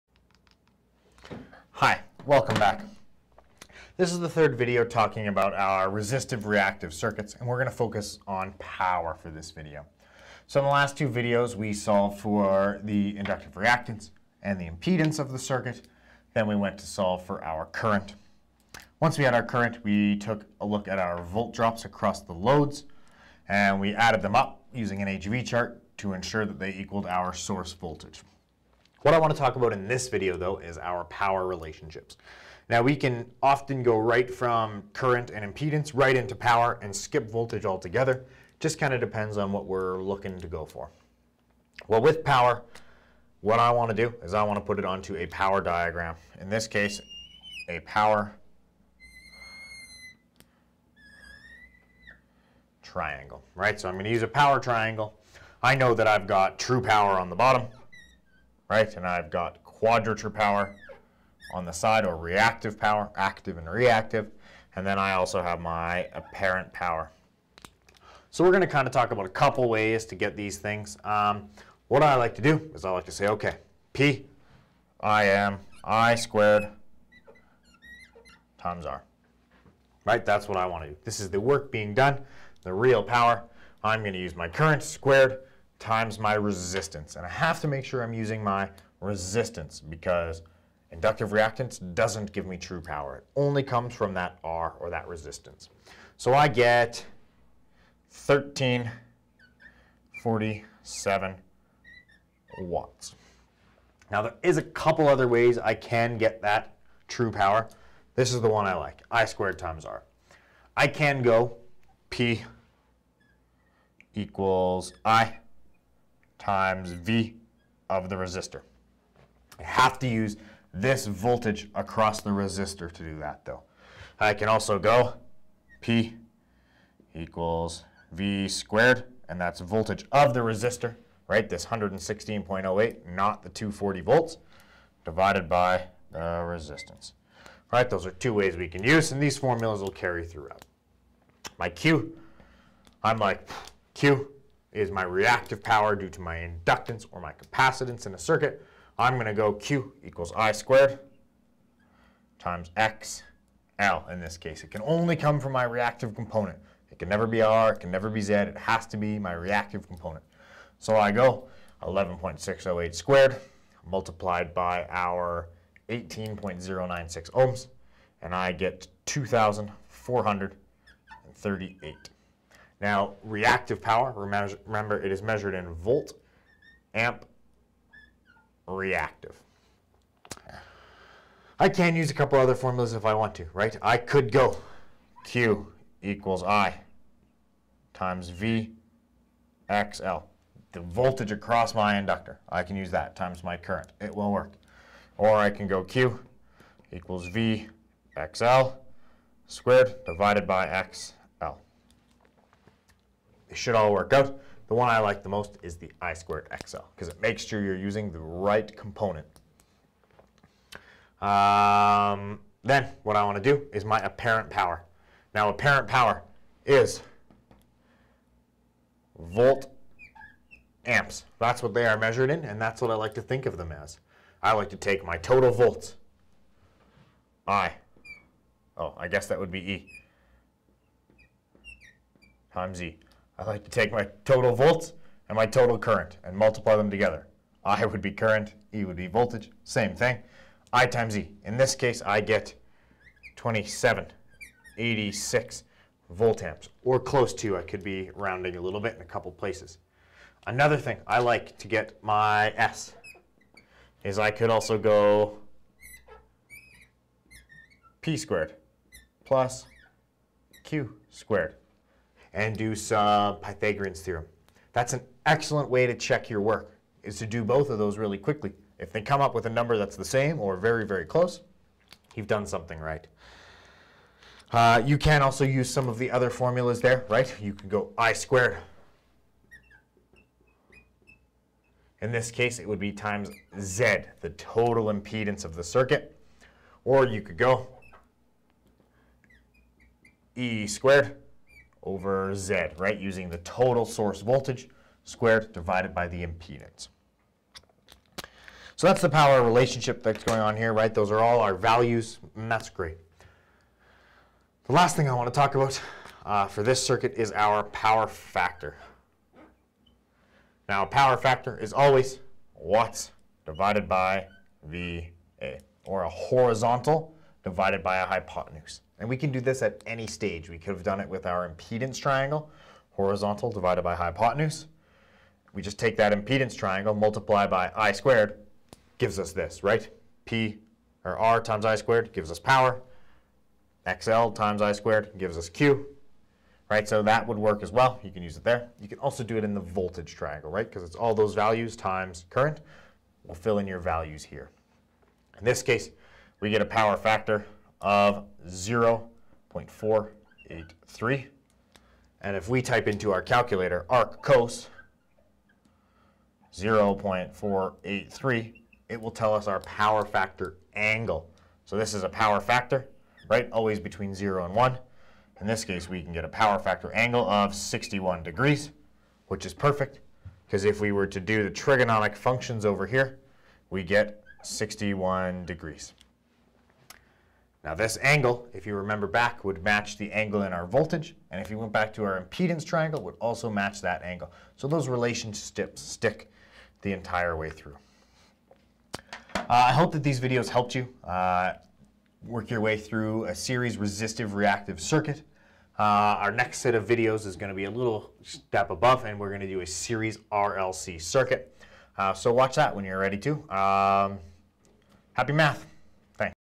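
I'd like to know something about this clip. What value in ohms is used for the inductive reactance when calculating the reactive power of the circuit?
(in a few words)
18.096 ohms.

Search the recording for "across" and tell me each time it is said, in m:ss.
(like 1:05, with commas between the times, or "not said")
0:21, 2:01, 3:11.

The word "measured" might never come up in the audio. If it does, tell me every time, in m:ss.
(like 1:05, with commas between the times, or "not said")
2:55, 3:41.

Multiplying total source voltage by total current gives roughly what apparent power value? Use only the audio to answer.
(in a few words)
2786 volt amps.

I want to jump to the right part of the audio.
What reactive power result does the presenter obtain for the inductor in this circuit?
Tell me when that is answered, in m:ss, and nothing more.
2:49.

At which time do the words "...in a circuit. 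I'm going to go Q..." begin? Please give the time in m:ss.
2:28.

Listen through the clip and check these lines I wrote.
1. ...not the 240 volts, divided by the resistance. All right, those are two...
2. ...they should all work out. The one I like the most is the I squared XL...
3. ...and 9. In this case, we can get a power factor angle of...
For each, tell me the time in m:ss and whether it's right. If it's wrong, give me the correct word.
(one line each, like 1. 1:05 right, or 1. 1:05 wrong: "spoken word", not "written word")
1. 2:13 right
2. 3:23 right
3. 6:04 wrong: "1", not "9".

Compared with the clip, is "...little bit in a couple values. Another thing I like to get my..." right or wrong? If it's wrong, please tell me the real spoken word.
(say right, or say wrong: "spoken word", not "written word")
wrong: "places", not "values".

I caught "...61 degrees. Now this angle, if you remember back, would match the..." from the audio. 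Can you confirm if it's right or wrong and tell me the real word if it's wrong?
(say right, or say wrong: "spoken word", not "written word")
right.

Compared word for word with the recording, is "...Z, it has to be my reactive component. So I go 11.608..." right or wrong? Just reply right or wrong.
right.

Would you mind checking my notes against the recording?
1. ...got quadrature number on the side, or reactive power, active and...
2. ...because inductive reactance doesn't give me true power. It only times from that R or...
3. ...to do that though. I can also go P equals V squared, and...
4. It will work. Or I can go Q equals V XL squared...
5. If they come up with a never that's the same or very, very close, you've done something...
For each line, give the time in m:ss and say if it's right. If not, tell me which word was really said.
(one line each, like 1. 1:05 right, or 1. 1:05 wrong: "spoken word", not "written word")
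1. 0:59 wrong: "power", not "number"
2. 1:29 wrong: "comes", not "times"
3. 2:02 right
4. 3:14 right
5. 4:28 wrong: "number", not "never".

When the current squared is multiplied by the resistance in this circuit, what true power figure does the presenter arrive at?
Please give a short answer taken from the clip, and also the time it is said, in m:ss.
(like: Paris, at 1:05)
1347 watts, at 1:38.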